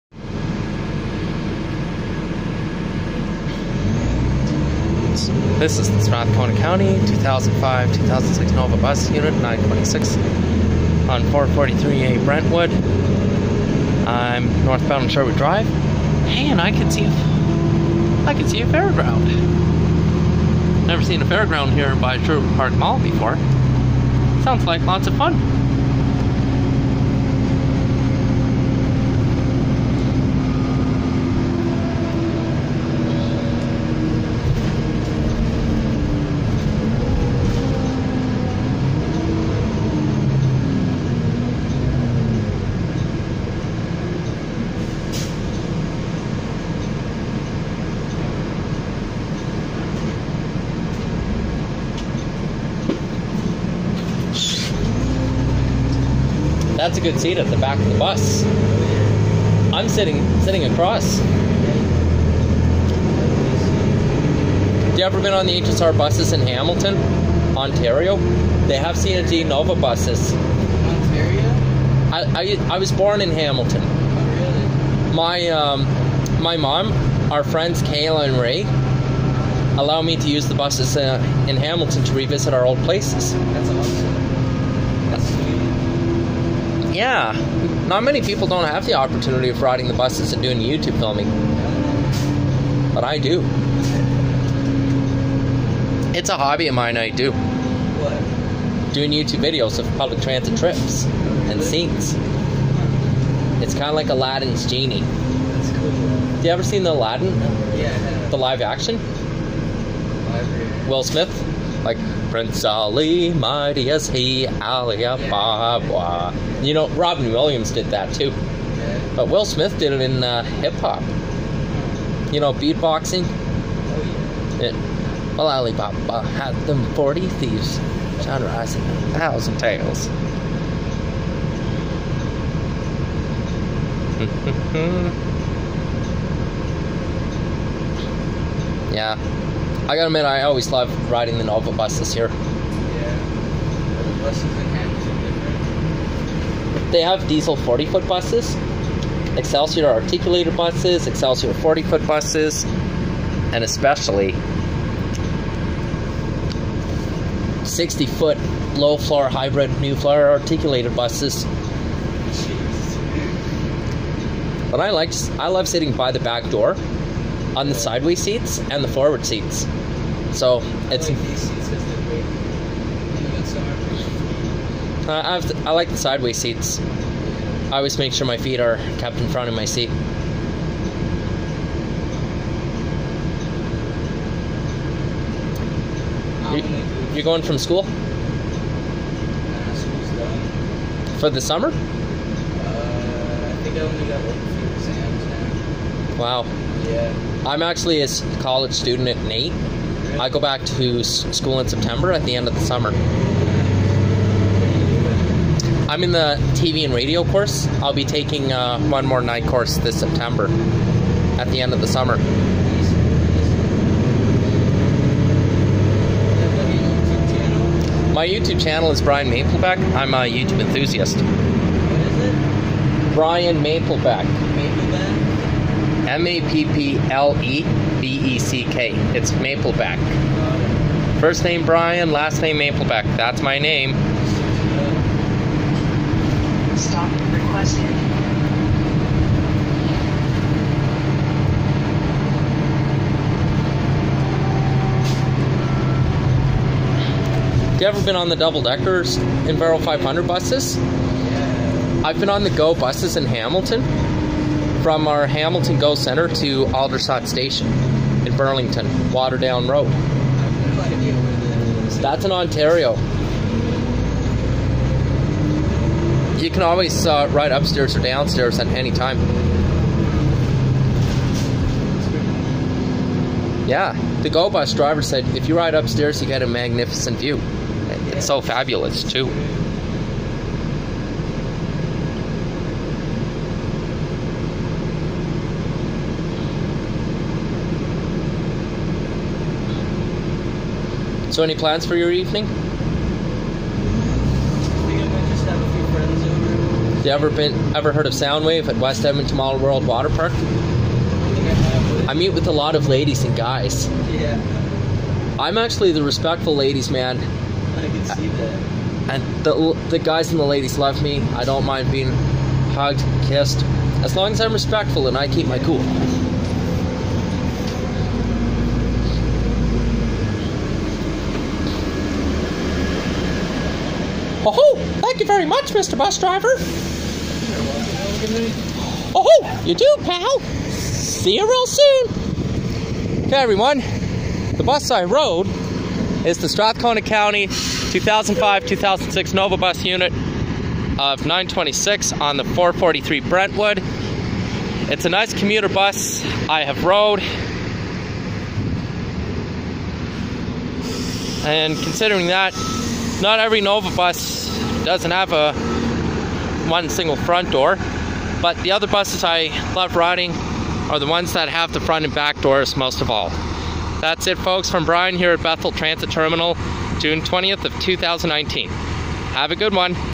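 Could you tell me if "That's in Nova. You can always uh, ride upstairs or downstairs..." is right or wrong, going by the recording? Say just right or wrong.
wrong.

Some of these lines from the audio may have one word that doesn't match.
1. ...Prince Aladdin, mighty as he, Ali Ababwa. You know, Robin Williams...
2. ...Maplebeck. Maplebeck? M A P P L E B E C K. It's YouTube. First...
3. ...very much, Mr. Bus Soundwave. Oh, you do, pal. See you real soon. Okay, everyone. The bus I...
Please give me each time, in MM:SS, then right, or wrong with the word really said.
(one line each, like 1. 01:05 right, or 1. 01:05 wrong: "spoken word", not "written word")
1. 01:52 wrong: "Ali", not "Aladdin"
2. 03:43 wrong: "Mapleback", not "YouTube"
3. 05:25 wrong: "Driver", not "Soundwave".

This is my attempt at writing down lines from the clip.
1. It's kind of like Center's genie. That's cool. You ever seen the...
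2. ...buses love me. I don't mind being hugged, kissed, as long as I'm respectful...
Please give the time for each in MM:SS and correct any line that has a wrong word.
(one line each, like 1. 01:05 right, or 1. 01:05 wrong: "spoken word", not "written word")
1. 01:43 wrong: "Aladdin", not "Center"
2. 05:10 wrong: "ladies", not "buses".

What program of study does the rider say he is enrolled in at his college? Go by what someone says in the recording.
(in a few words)
TV and radio.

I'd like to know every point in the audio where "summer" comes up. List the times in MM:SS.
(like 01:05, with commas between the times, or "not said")
03:11, 03:22, 03:31.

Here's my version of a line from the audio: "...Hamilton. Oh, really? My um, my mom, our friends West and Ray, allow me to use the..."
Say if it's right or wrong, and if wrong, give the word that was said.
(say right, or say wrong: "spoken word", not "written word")
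wrong: "Kayla", not "West".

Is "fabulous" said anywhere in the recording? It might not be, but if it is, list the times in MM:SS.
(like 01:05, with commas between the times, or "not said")
04:38.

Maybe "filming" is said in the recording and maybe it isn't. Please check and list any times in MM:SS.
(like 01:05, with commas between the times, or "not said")
01:30.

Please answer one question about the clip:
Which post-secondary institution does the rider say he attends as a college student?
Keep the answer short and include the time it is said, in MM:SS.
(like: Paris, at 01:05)
NAIT, at 03:19.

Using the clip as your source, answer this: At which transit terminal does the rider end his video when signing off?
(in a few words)
Bethel Transit Terminal.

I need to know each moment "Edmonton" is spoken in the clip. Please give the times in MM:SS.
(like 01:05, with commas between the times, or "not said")
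04:59.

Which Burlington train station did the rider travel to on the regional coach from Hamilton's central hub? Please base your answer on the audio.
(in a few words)
Aldershot Station.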